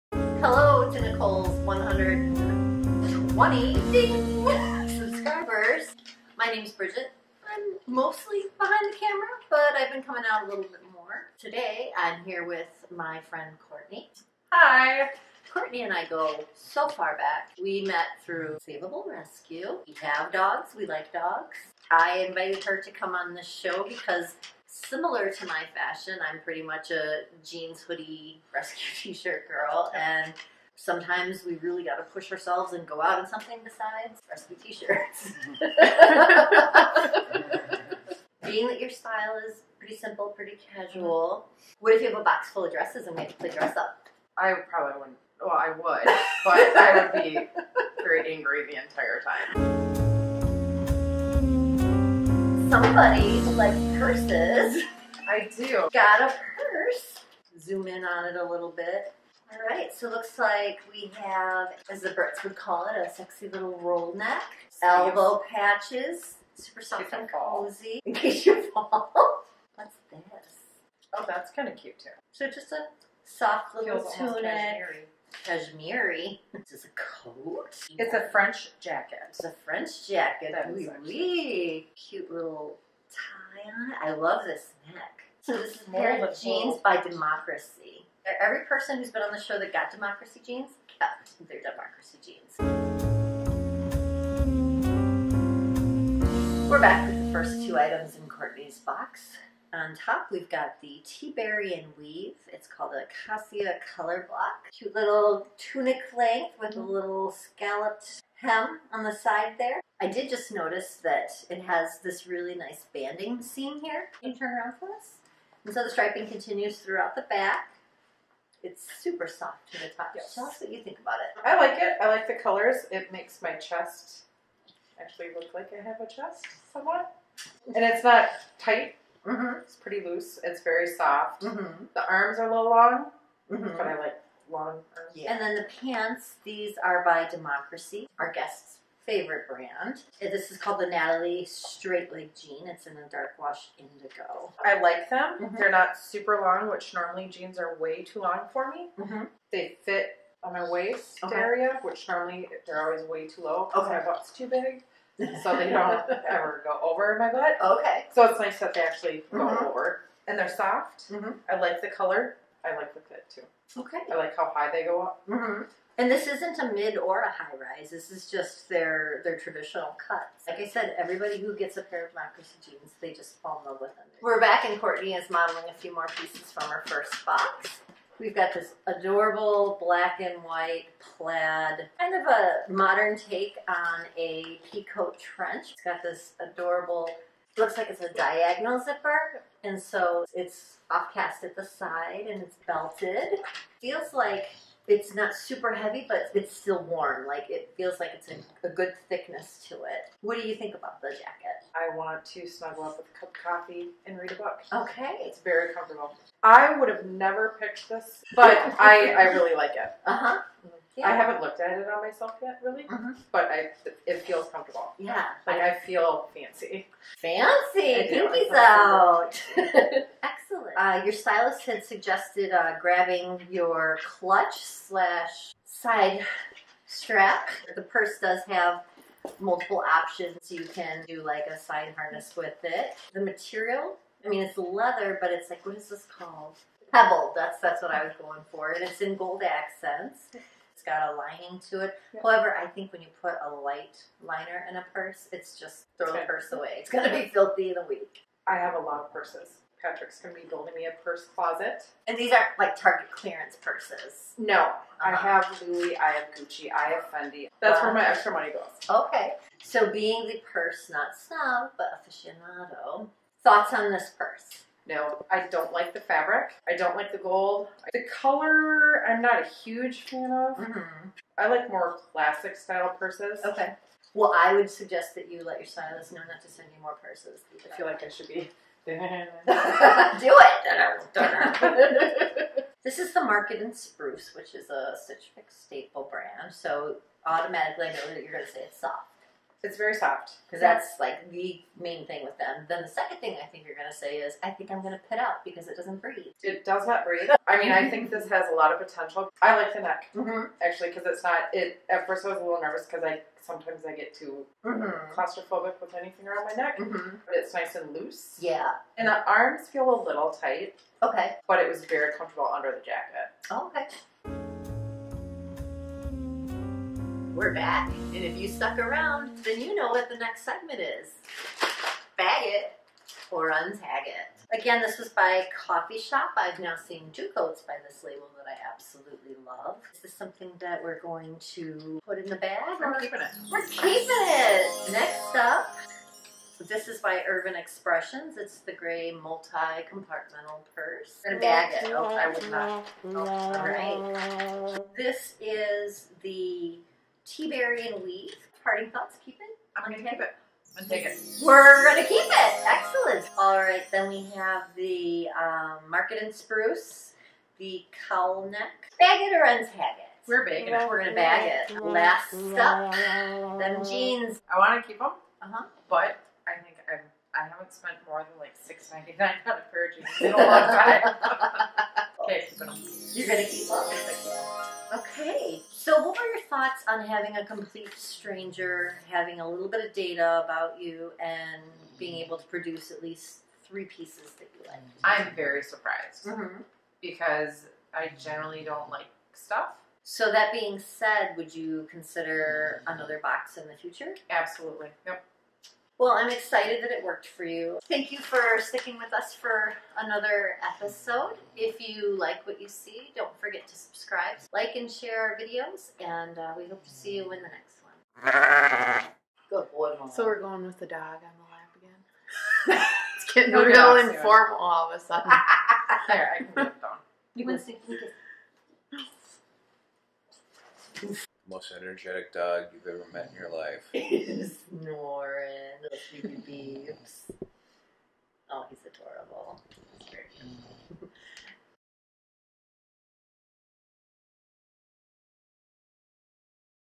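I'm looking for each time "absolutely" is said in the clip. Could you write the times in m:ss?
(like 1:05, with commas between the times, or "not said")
5:28, 6:34.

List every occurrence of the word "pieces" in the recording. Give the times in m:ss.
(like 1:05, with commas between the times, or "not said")
2:56, 6:23.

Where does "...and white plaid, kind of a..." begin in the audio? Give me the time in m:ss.
3:00.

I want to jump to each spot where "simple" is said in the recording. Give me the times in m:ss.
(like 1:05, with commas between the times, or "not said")
0:39.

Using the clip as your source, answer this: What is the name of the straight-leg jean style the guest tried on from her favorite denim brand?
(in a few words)
Natalie Straight Leg Jean.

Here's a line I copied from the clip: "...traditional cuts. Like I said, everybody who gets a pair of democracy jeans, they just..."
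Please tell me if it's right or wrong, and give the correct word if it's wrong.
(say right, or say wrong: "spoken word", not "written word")
right.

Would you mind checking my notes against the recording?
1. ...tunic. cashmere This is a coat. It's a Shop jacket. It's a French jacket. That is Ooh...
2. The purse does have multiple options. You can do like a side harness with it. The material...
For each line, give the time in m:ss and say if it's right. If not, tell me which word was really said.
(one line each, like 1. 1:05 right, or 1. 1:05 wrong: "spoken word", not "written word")
1. 1:14 wrong: "French", not "Shop"
2. 3:47 right.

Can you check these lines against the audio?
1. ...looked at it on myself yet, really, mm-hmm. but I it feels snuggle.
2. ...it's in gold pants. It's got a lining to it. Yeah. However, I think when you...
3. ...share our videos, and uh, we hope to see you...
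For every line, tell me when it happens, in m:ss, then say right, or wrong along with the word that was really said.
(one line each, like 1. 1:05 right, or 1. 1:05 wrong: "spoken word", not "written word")
1. 3:31 wrong: "comfortable", not "snuggle"
2. 3:58 wrong: "accents", not "pants"
3. 6:44 right.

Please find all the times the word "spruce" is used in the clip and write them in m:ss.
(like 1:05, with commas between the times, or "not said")
4:43, 5:56.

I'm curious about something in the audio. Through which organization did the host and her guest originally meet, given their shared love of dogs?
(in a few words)
Savable Rescue.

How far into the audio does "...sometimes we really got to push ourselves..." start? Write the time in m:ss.
0:30.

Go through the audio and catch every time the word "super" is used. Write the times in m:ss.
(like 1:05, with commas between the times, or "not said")
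1:06, 1:59, 2:25, 3:15.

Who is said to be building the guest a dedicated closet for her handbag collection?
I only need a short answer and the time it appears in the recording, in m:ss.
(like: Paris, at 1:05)
Patrick, at 4:09.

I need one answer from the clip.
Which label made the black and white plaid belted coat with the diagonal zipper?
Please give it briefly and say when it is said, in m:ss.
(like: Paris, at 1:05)
Coffee Shop, at 5:25.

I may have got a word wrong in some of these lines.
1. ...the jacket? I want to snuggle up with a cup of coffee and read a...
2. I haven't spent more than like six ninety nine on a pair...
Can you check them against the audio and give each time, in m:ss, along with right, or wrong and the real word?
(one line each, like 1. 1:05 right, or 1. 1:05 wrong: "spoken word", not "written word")
1. 3:21 right
2. 6:07 right.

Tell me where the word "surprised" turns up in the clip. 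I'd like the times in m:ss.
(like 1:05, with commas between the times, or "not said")
6:25.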